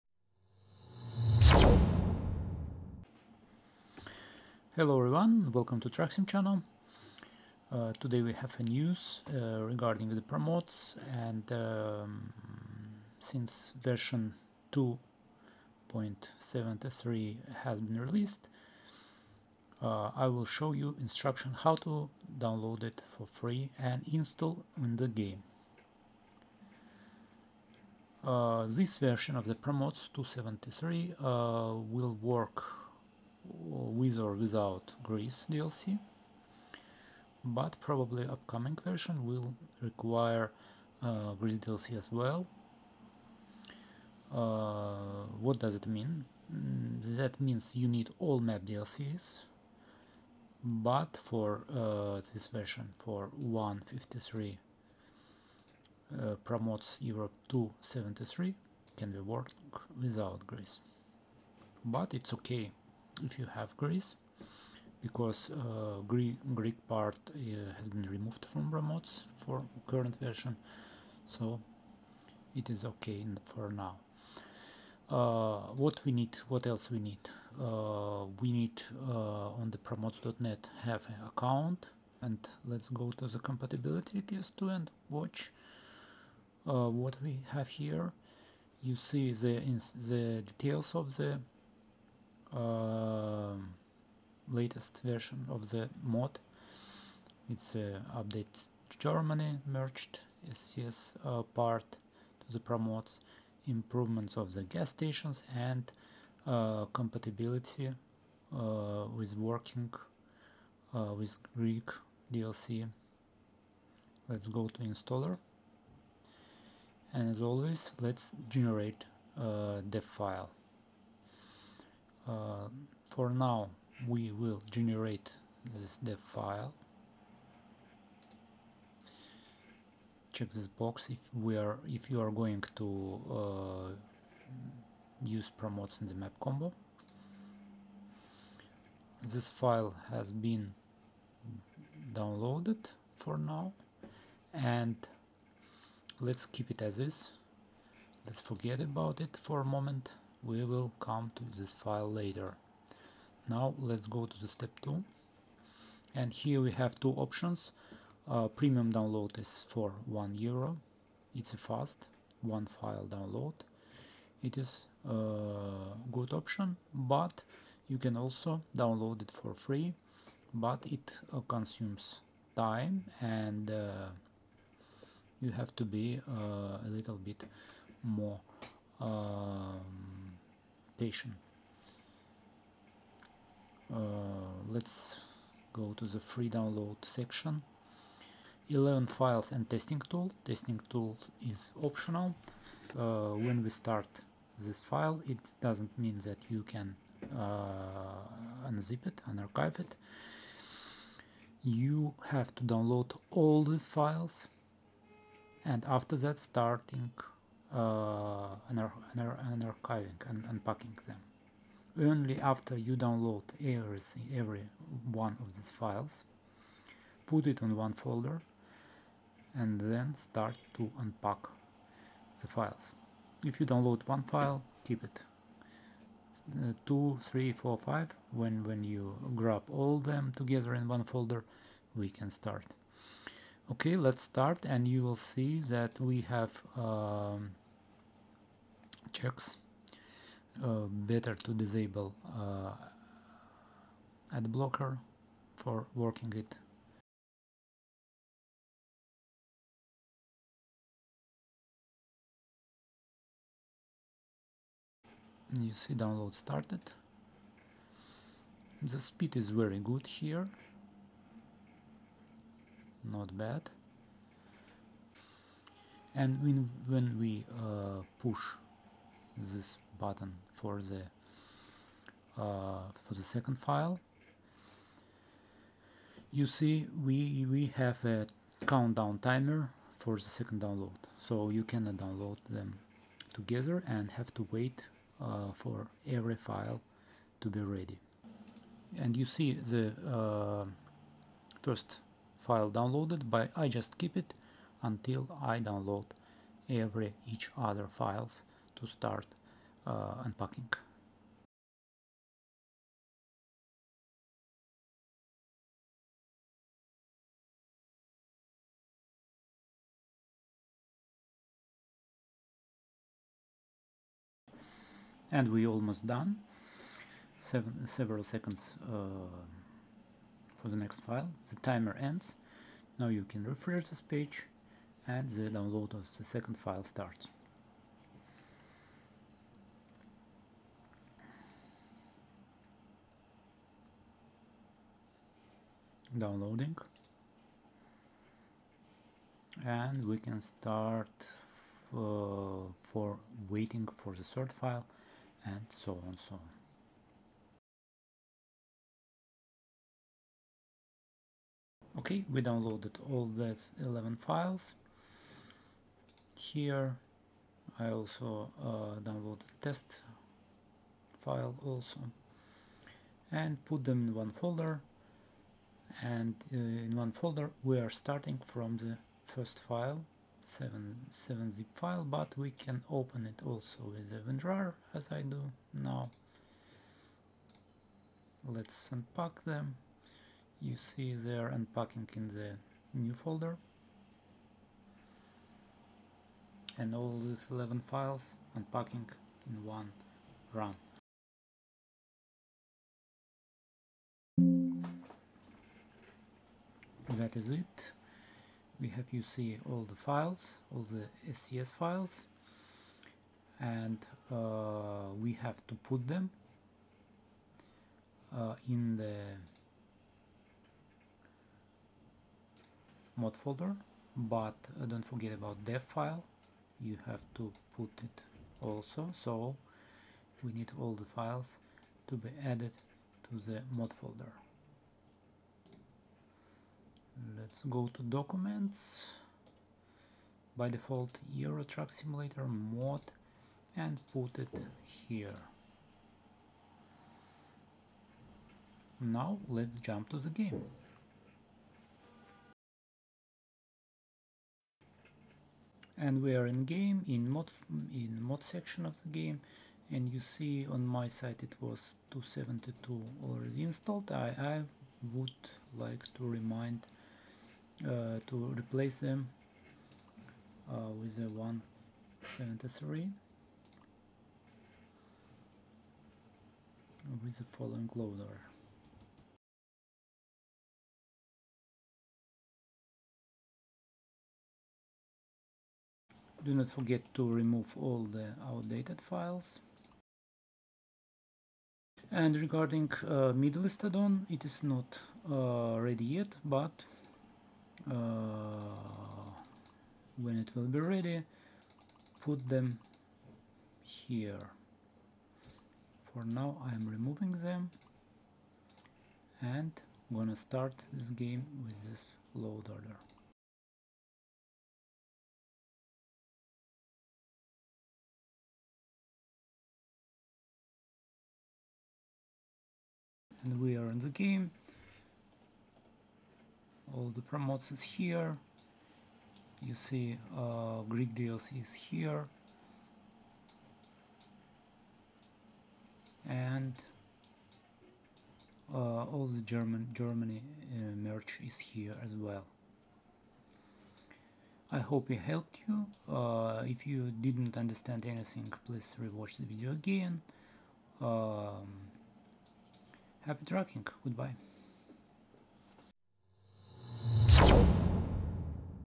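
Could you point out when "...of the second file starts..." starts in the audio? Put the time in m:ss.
5:25.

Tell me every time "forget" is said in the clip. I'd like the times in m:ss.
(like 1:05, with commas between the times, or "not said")
2:28, 6:55, 7:56.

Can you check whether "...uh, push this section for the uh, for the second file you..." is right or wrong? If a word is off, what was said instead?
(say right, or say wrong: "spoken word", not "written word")
wrong: "button", not "section".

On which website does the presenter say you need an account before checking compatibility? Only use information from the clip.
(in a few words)
promods.net.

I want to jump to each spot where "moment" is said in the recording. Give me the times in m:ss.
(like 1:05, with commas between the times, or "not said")
2:29.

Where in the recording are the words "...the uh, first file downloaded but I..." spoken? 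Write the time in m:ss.
4:49.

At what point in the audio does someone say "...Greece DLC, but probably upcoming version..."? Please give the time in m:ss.
0:35.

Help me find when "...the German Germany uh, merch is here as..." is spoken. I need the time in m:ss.
8:49.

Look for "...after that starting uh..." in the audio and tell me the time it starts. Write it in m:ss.
3:25.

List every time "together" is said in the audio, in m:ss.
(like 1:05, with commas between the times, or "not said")
3:50, 4:43.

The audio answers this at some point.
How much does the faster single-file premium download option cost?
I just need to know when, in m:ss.
2:40.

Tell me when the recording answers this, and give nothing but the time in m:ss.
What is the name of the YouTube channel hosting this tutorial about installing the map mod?
0:05.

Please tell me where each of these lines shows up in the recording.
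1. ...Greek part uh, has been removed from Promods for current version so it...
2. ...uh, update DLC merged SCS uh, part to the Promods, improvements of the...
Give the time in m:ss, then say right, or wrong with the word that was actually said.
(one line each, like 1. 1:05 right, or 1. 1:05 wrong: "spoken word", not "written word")
1. 1:06 right
2. 1:37 wrong: "Germany", not "DLC".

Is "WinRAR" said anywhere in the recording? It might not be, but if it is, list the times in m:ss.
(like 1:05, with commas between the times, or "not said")
6:14.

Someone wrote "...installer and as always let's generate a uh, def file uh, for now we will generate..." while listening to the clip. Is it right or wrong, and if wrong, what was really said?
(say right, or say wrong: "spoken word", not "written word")
right.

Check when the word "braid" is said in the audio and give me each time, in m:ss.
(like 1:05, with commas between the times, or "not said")
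not said.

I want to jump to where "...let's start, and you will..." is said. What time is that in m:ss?
3:53.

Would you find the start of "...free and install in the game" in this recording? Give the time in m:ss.
0:23.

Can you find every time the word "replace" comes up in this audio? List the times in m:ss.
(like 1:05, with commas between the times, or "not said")
7:38.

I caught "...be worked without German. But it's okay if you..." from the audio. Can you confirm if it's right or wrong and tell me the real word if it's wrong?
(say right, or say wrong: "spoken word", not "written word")
wrong: "Greece", not "German".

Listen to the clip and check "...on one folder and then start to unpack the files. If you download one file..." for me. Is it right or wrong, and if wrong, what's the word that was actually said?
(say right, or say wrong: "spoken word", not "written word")
right.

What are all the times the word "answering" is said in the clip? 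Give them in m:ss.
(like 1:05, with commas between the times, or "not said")
not said.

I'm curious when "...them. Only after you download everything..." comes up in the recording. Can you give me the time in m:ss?
3:31.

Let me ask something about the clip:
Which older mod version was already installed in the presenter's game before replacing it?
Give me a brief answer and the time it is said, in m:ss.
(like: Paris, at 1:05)
272, at 7:32.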